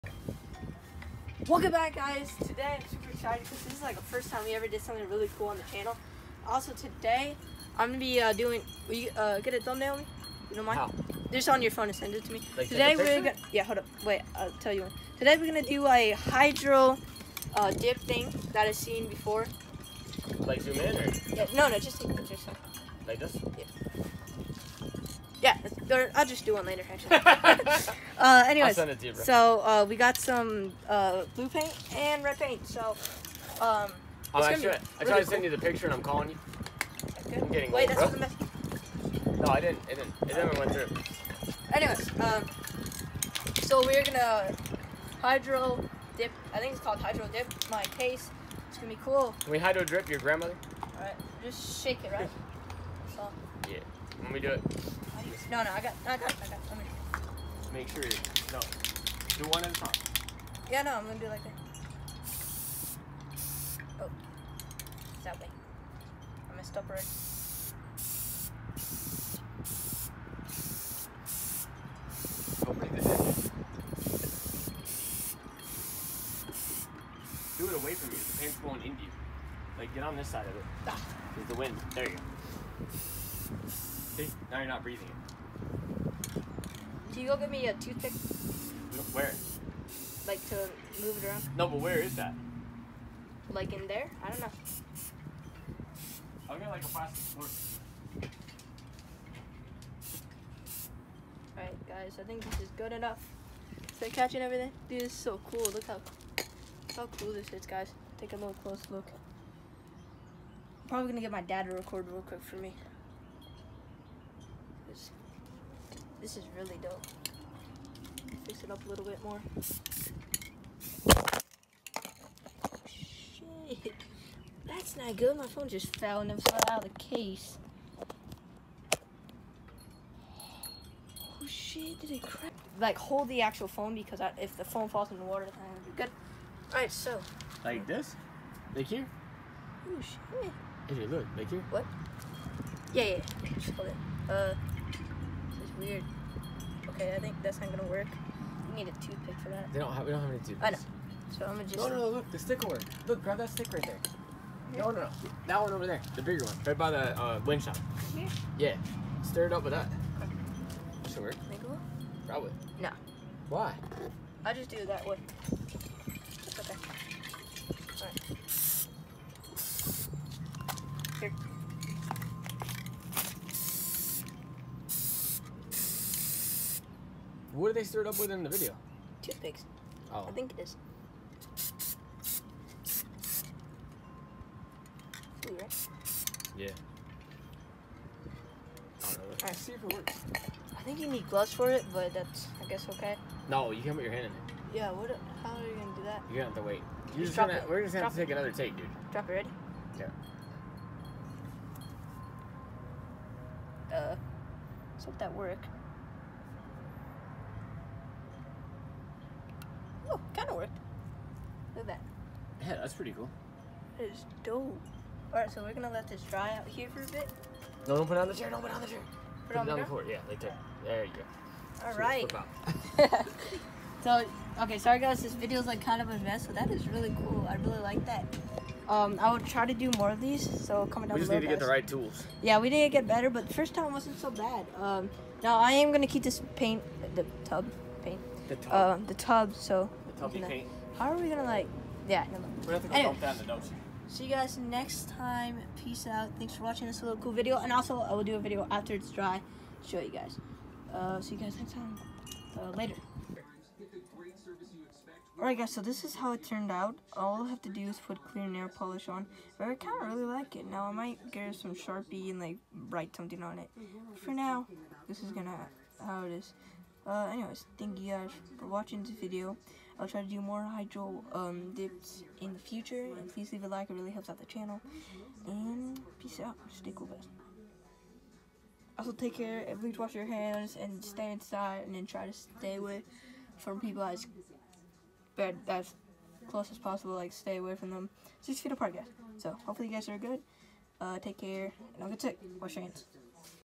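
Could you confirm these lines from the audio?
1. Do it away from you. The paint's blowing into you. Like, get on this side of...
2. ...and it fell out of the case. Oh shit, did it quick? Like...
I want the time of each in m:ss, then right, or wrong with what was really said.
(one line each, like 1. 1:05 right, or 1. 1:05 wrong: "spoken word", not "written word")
1. 1:17 right
2. 2:06 wrong: "crack", not "quick".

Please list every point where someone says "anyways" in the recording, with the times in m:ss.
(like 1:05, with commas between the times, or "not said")
0:28, 0:41, 4:02, 4:27.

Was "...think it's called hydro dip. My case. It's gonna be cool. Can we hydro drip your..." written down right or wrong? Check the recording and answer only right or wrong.
right.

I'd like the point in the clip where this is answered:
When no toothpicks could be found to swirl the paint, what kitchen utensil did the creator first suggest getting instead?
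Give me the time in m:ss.
1:36.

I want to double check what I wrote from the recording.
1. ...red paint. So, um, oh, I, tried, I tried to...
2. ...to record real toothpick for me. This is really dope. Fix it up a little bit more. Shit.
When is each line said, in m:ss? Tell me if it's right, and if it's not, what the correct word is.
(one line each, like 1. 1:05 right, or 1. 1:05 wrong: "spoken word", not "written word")
1. 0:32 right
2. 1:51 wrong: "quick", not "toothpick".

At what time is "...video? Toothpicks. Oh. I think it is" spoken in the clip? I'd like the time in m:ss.
2:58.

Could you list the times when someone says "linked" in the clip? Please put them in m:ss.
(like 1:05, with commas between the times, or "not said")
not said.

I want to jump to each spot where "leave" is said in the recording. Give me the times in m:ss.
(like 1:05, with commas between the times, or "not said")
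4:33.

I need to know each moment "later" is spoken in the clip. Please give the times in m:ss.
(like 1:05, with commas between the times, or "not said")
0:26, 4:12.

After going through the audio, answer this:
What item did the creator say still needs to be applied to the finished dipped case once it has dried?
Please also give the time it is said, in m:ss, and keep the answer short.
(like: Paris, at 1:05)
clear nail polish, at 4:18.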